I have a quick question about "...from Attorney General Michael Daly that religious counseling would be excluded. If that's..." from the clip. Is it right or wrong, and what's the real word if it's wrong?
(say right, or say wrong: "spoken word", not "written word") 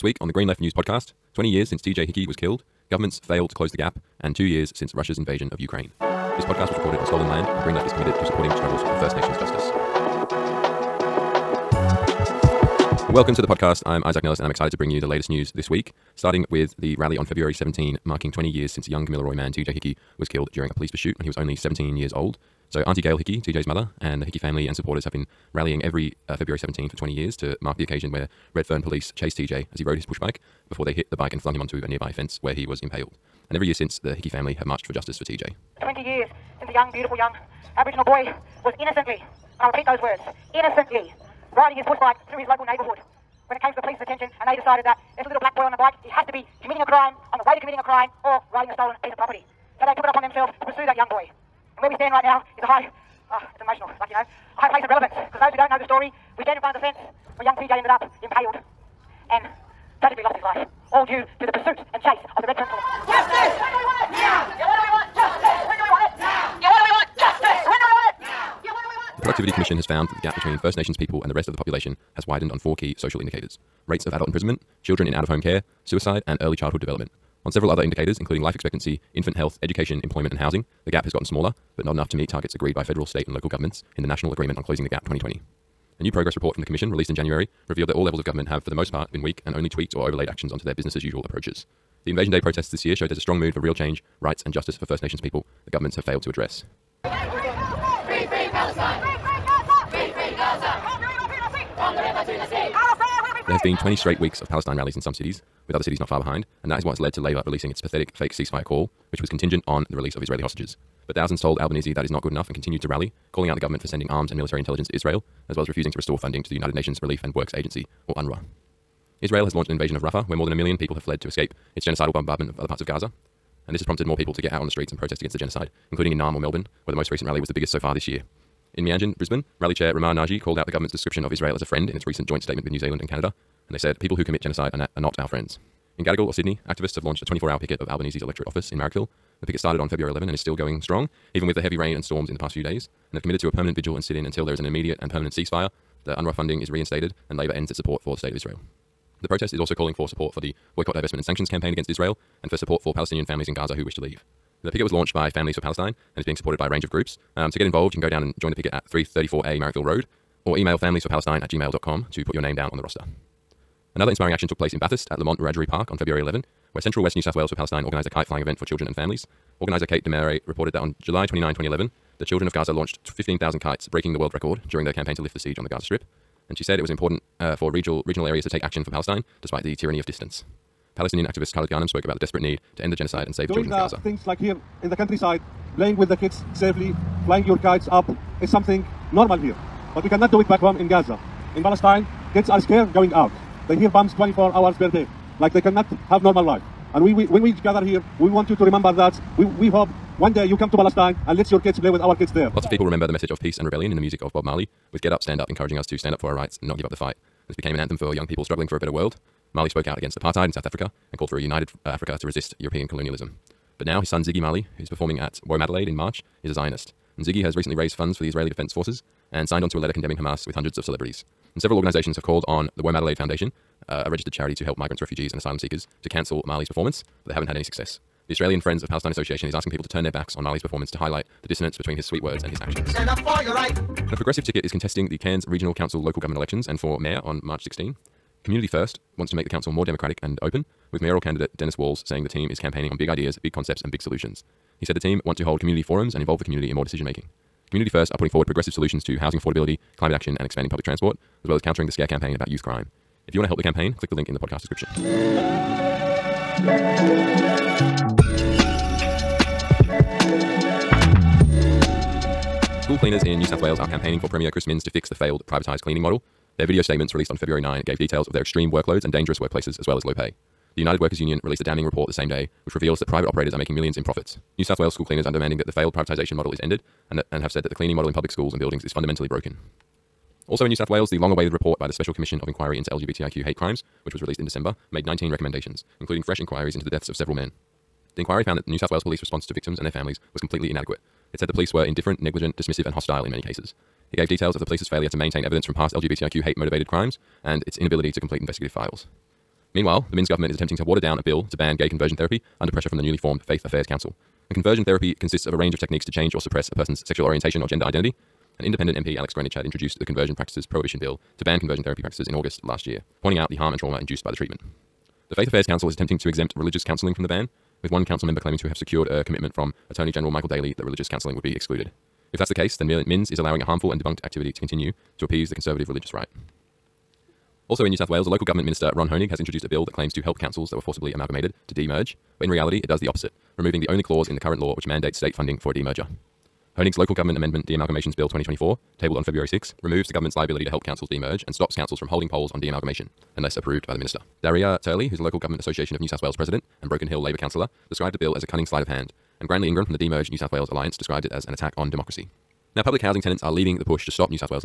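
right.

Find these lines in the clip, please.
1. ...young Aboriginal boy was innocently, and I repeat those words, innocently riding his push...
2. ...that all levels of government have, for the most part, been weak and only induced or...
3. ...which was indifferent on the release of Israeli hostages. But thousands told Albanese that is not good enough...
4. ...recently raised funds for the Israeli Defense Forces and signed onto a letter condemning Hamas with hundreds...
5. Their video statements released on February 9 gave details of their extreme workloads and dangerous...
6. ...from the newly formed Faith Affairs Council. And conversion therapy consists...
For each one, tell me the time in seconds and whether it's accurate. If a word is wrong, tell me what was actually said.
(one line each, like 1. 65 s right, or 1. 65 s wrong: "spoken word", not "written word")
1. 37 s right
2. 87 s wrong: "tweaked", not "induced"
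3. 109 s wrong: "contingent", not "indifferent"
4. 217 s right
5. 266 s right
6. 302 s right.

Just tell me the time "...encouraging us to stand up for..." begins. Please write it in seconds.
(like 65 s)
205 s.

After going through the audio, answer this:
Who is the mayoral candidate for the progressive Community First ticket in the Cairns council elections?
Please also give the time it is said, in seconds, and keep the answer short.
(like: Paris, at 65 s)
Dennis Walls, at 241 s.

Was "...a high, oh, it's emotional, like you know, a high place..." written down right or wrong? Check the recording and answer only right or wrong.
right.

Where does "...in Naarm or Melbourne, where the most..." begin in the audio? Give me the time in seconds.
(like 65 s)
126 s.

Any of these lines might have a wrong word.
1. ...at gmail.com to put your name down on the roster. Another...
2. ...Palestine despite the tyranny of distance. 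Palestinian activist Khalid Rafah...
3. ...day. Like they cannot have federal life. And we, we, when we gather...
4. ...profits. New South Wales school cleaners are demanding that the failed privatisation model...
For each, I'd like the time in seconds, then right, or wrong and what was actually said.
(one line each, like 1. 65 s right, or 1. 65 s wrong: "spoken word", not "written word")
1. 161 s right
2. 178 s wrong: "Ghanem", not "Rafah"
3. 194 s wrong: "normal", not "federal"
4. 274 s right.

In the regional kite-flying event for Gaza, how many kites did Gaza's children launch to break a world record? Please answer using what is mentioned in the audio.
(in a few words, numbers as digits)
15,000.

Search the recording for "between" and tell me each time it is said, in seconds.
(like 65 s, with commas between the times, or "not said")
70 s, 231 s.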